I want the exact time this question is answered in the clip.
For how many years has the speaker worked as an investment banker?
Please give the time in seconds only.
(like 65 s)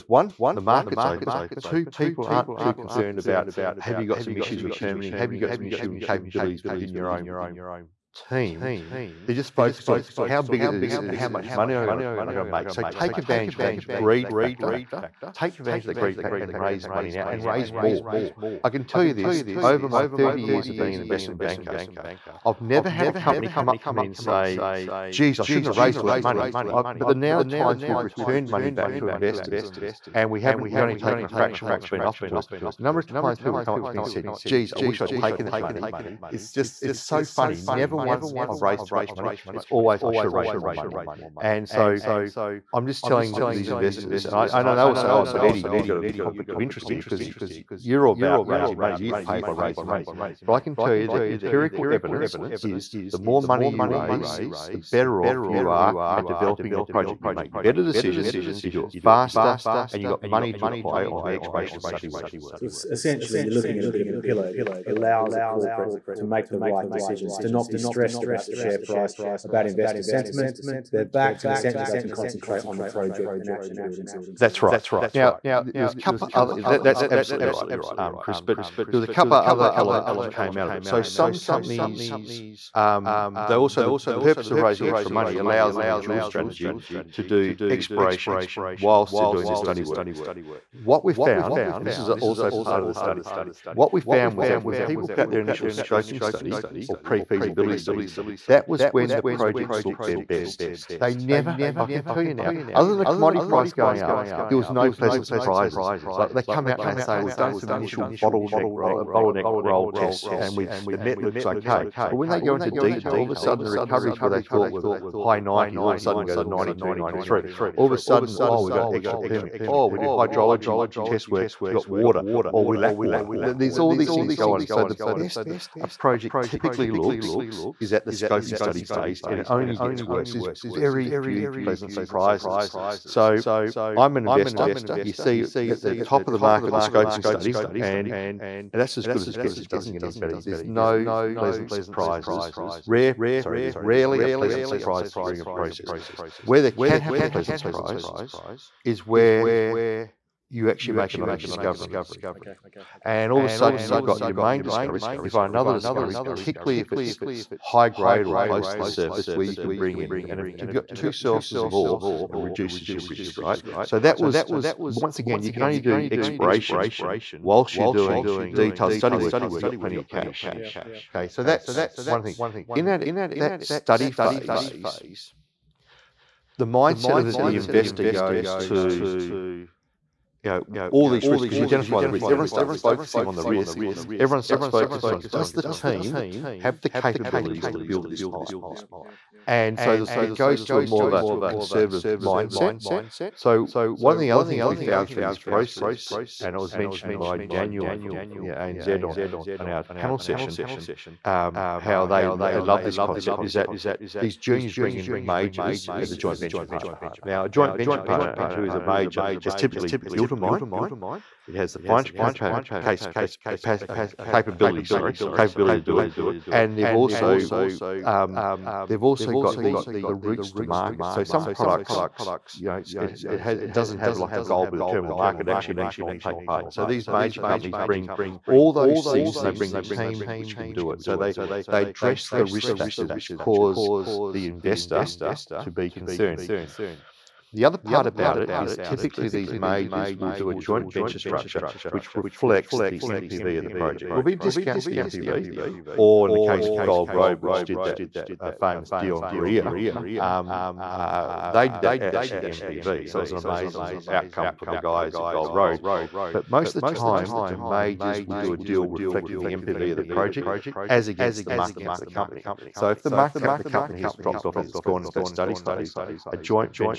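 20 s.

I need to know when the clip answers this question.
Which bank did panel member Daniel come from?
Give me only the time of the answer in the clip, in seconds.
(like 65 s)
198 s.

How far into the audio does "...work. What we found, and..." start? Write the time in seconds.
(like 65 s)
89 s.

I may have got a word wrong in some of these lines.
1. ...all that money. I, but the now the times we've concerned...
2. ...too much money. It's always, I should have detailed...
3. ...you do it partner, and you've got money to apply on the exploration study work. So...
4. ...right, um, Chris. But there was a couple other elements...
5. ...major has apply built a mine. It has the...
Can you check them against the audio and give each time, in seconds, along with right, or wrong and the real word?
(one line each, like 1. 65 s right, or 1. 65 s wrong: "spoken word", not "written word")
1. 26 s wrong: "returned", not "concerned"
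2. 38 s wrong: "raised", not "detailed"
3. 58 s wrong: "faster", not "partner"
4. 77 s right
5. 208 s wrong: "typically", not "apply".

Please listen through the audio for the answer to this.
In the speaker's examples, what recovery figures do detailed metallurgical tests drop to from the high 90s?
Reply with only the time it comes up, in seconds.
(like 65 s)
116 s.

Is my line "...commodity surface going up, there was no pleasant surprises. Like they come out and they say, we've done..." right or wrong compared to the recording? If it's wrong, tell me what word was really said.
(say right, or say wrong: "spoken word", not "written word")
wrong: "price", not "surface".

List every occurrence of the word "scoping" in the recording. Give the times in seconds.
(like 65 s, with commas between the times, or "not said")
95 s, 128 s, 136 s.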